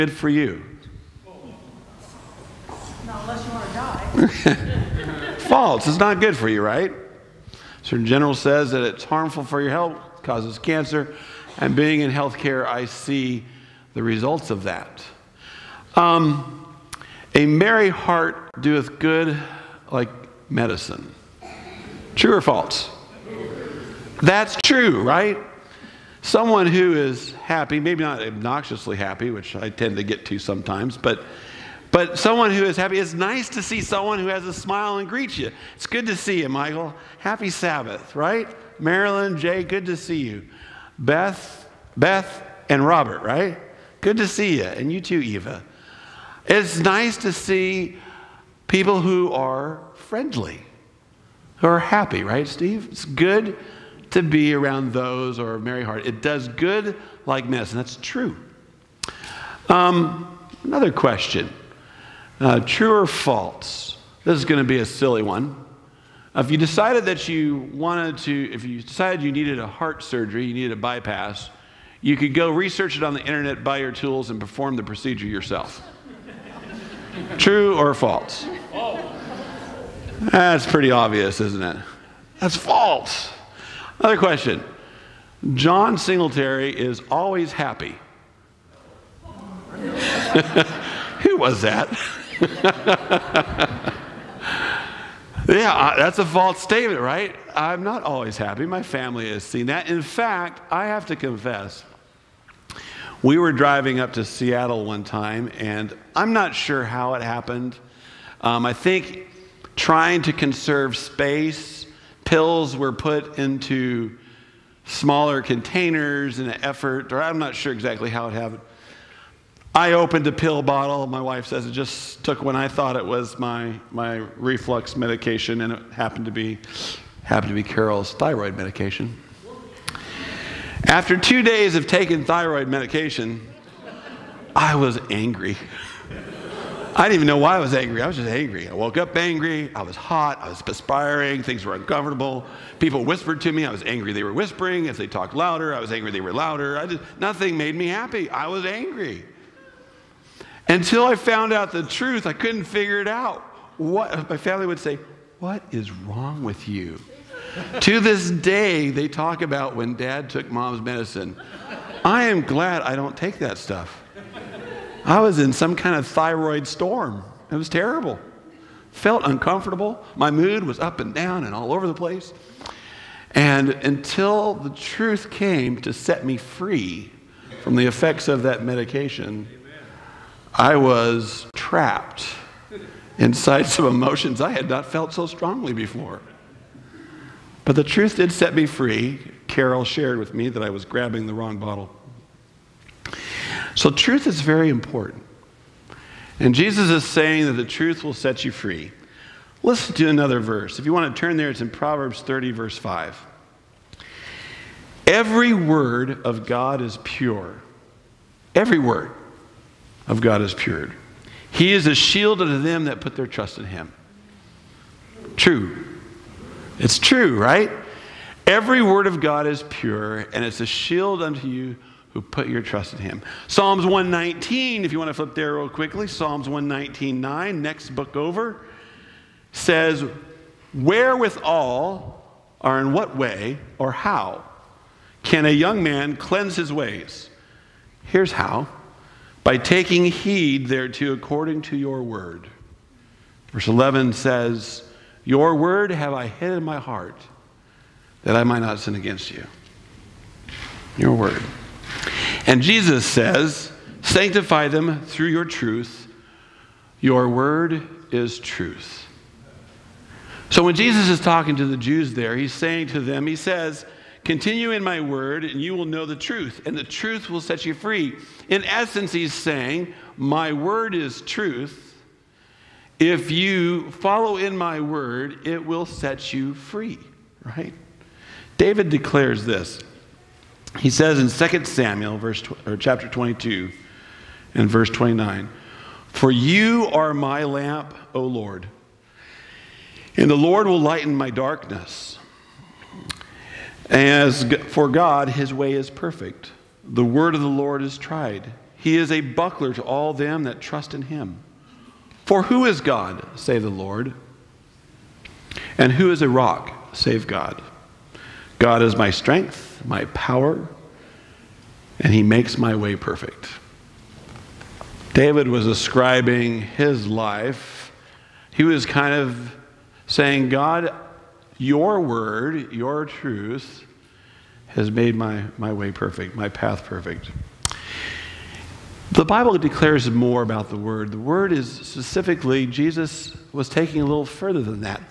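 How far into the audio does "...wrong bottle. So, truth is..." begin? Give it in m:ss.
3:11.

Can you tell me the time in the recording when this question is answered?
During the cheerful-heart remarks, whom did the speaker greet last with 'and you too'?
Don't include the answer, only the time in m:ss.
0:45.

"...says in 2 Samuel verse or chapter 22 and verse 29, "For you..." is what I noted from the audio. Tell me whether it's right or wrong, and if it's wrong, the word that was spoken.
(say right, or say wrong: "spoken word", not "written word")
right.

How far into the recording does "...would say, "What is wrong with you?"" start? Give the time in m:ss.
2:34.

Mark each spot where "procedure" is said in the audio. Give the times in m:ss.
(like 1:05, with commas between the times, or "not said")
1:14.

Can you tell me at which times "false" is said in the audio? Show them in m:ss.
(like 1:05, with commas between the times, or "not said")
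0:05, 0:22, 1:03, 1:17, 1:22, 1:36.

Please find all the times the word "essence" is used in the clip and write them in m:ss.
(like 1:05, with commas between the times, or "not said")
4:28.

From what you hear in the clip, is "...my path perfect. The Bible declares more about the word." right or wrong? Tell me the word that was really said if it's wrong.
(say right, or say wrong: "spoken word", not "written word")
right.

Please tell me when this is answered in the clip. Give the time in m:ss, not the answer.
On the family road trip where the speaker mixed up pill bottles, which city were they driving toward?
1:44.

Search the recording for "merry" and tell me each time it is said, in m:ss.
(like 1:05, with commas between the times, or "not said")
0:17, 0:55.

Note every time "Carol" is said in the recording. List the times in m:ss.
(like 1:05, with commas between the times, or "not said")
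2:07, 3:09.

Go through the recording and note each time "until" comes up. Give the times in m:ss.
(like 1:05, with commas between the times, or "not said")
2:30, 2:53.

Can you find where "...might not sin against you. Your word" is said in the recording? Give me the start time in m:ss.
4:08.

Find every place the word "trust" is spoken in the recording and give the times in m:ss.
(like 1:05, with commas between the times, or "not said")
3:33, 3:42, 5:00.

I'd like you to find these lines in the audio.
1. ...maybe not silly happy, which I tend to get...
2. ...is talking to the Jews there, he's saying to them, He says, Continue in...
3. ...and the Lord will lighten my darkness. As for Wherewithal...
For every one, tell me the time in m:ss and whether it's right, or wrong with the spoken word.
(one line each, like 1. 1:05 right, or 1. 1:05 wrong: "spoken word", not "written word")
1. 0:27 wrong: "obnoxiously", not "silly"
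2. 4:21 right
3. 4:50 wrong: "God", not "Wherewithal".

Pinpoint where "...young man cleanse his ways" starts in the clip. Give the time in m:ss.
3:55.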